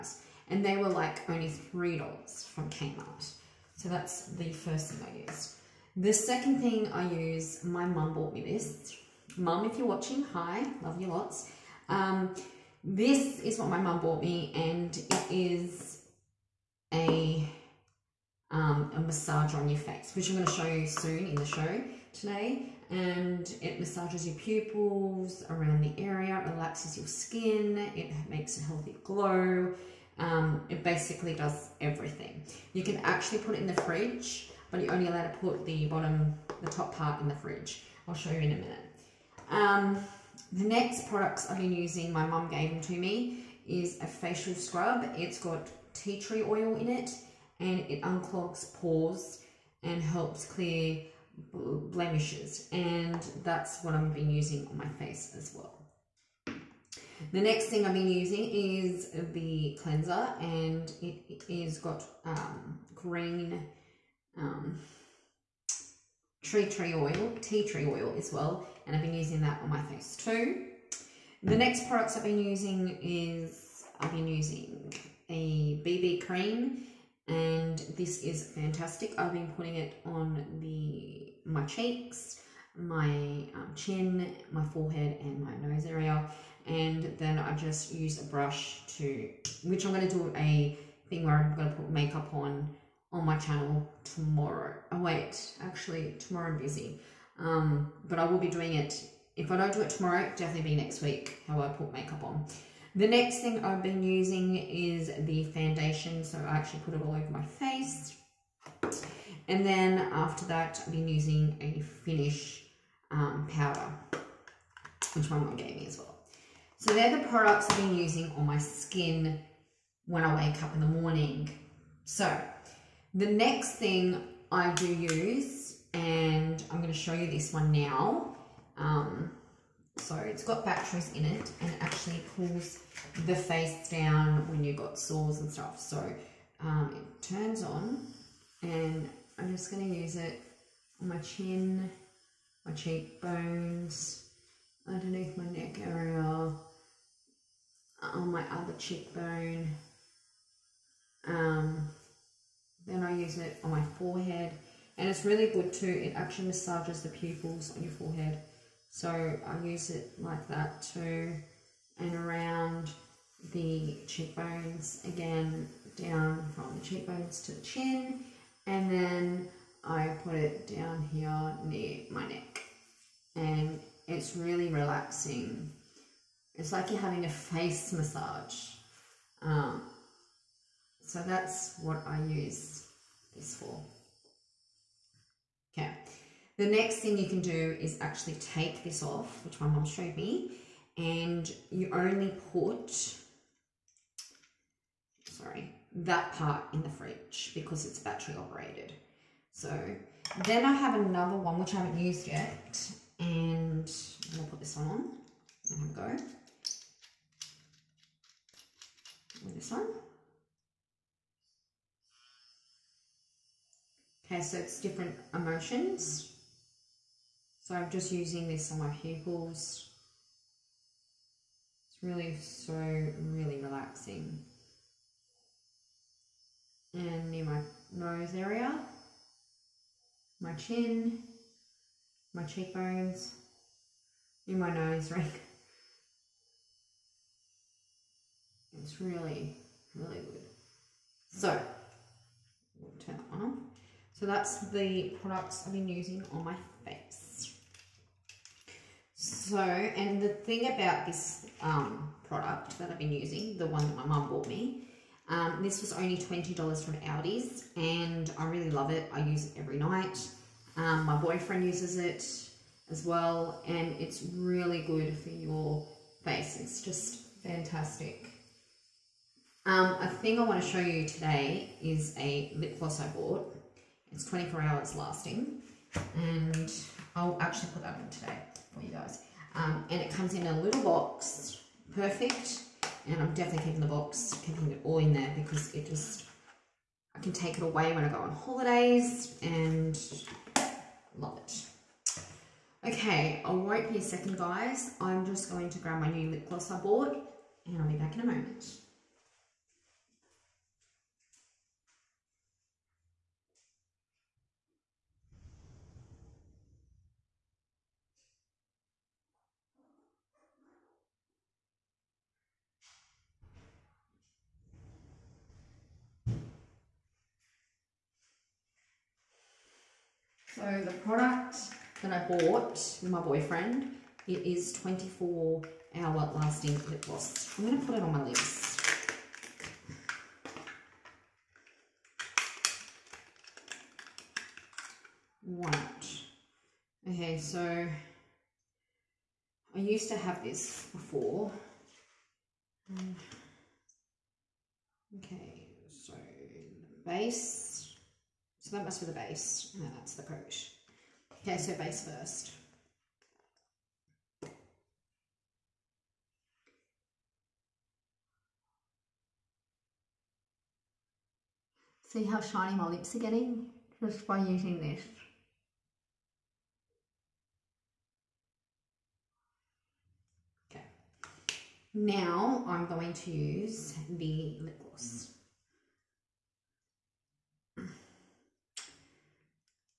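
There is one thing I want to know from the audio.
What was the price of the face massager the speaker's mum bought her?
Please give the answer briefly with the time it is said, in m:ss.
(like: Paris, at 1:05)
$20, at 4:16.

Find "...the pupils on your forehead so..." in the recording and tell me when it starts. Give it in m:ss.
2:37.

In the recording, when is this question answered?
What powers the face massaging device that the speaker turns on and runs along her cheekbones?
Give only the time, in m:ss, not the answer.
2:10.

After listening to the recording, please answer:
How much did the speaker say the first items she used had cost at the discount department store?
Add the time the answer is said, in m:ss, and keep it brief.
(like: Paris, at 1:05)
$3, at 0:01.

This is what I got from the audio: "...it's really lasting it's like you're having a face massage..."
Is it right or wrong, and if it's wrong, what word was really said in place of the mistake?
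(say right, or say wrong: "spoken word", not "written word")
wrong: "relaxing", not "lasting".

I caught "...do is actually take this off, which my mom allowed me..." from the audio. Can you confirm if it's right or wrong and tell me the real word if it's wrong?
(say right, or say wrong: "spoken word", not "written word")
wrong: "showed", not "allowed".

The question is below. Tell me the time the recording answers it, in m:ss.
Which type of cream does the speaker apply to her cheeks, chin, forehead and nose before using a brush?
1:15.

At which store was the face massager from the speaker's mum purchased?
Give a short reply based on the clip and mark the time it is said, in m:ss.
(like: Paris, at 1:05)
Aldi, at 4:16.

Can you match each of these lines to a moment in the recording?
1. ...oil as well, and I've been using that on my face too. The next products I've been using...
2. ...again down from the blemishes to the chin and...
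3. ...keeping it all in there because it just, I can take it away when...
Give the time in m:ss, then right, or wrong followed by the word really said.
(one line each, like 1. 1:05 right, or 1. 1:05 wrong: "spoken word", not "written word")
1. 1:07 right
2. 2:45 wrong: "cheekbones", not "blemishes"
3. 4:44 right.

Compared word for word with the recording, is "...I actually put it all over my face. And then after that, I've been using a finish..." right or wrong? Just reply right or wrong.
right.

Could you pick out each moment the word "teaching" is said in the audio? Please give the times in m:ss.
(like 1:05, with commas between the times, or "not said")
not said.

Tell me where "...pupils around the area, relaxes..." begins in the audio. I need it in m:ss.
0:24.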